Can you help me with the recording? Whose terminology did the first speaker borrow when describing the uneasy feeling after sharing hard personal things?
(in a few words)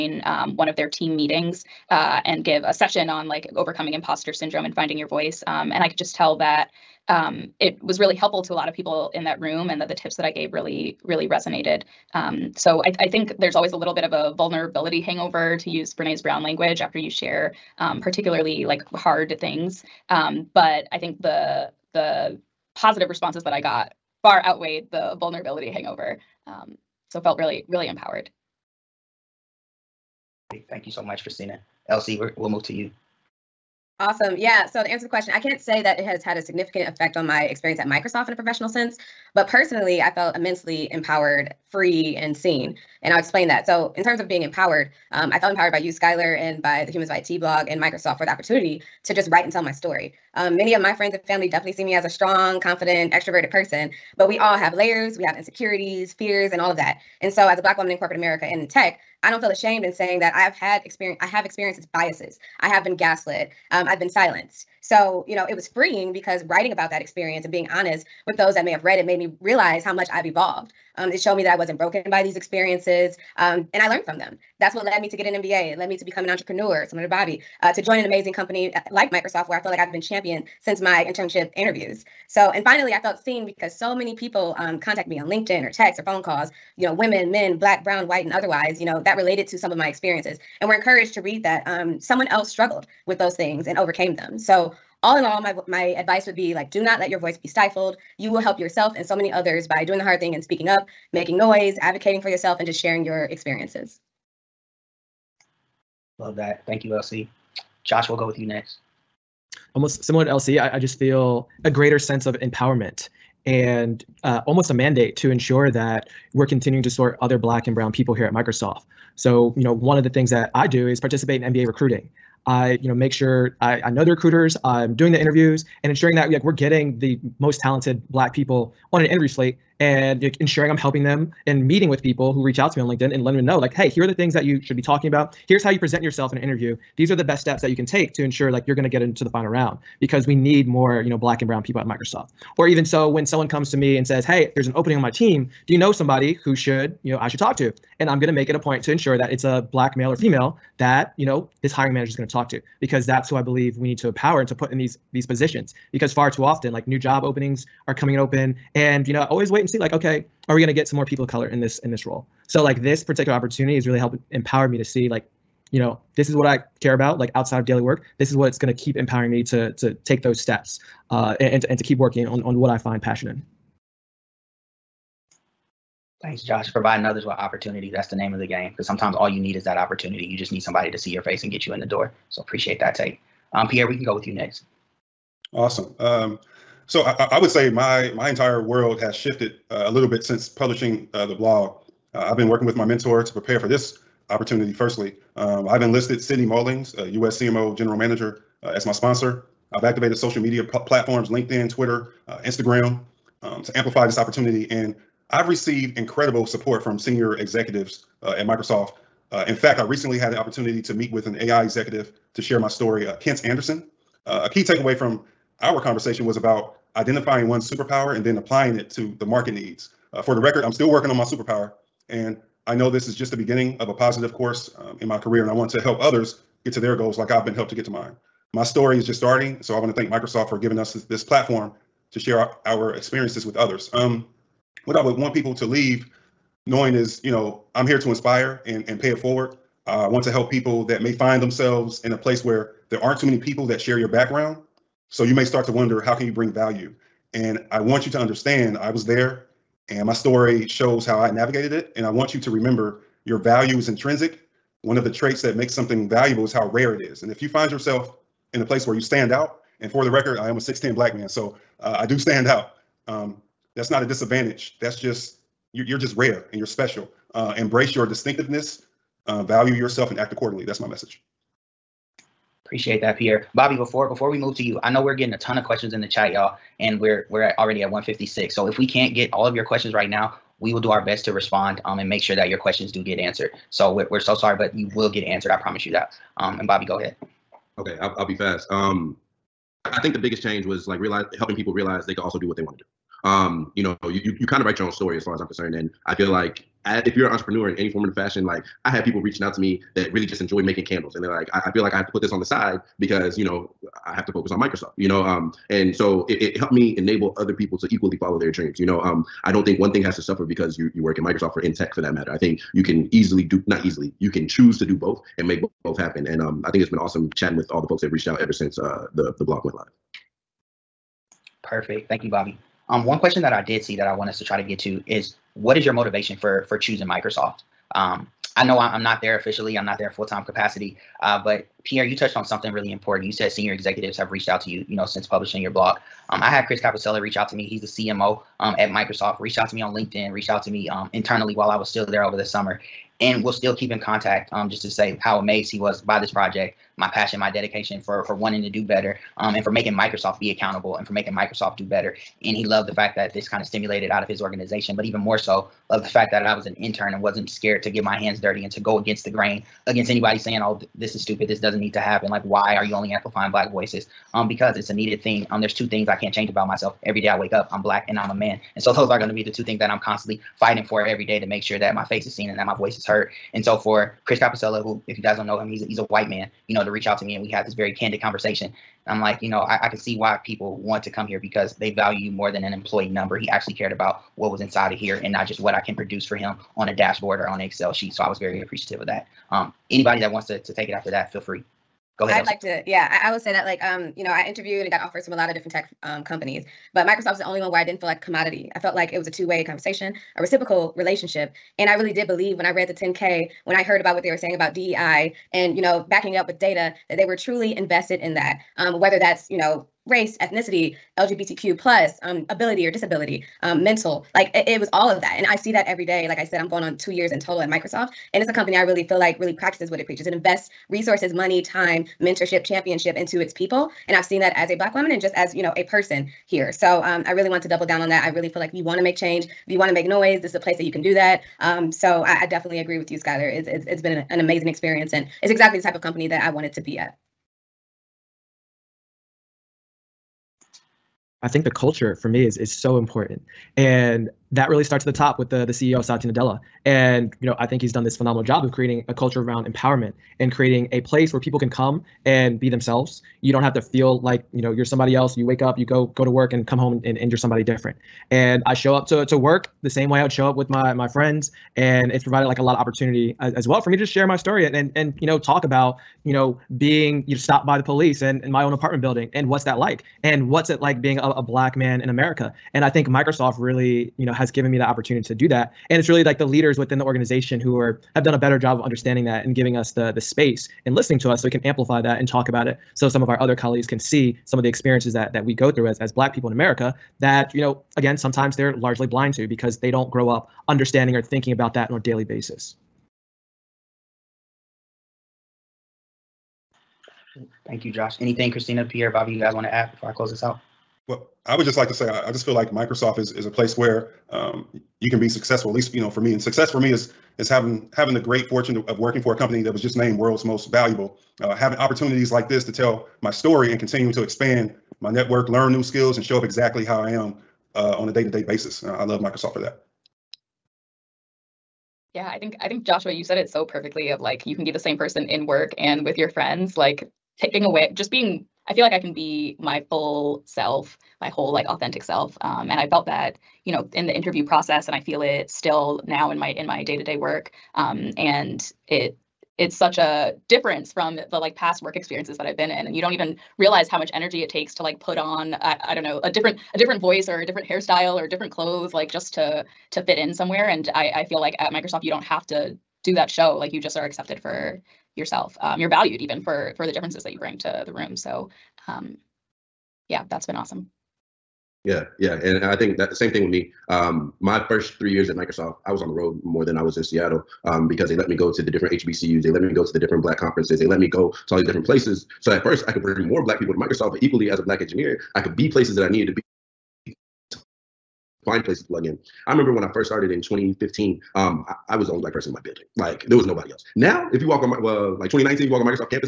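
Brene Brown.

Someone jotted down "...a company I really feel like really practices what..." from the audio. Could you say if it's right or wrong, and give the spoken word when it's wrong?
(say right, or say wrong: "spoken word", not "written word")
right.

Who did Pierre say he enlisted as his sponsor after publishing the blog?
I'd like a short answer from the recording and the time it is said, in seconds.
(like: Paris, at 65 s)
Sydney Mullings, at 196 s.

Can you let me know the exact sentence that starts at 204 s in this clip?
And I've received incredible support from senior executives uh, at Microsoft.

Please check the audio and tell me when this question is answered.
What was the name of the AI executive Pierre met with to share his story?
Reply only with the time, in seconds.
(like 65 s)
213 s.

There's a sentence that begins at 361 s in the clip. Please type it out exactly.
This doesn't need to happen." Like, why are you only amplifying Black voices?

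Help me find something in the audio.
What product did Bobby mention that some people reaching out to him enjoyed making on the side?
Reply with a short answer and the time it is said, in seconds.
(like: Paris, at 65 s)
candles, at 300 s.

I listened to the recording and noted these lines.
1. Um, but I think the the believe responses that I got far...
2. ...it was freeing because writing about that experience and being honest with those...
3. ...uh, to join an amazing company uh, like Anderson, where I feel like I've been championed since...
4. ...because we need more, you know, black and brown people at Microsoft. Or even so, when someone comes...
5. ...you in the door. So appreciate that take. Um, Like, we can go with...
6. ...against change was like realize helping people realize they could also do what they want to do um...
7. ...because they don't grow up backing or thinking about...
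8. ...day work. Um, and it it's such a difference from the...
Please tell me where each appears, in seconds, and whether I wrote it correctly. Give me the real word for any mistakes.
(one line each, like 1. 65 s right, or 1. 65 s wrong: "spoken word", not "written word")
1. 20 s wrong: "positive", not "believe"
2. 65 s right
3. 77 s wrong: "Microsoft", not "Anderson"
4. 139 s right
5. 181 s wrong: "Pierre", not "Like"
6. 290 s wrong: "biggest", not "against"
7. 489 s wrong: "understanding", not "backing"
8. 537 s right.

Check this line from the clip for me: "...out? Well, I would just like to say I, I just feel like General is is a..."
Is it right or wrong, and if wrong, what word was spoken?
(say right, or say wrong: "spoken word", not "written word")
wrong: "Microsoft", not "General".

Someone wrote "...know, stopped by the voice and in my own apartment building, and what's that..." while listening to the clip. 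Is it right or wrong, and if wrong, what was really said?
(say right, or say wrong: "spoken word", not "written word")
wrong: "police", not "voice".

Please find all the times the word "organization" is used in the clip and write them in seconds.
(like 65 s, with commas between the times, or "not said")
354 s, 477 s.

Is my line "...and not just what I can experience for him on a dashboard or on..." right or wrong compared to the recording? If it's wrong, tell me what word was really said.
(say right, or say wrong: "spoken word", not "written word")
wrong: "produce", not "experience".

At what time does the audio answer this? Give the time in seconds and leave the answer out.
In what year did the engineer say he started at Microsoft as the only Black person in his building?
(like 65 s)
580 s.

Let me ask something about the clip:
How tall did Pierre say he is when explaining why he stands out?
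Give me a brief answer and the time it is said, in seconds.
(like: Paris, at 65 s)
6'10, at 260 s.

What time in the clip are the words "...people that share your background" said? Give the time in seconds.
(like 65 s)
243 s.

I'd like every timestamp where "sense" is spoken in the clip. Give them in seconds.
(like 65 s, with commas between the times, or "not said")
38 s, 111 s.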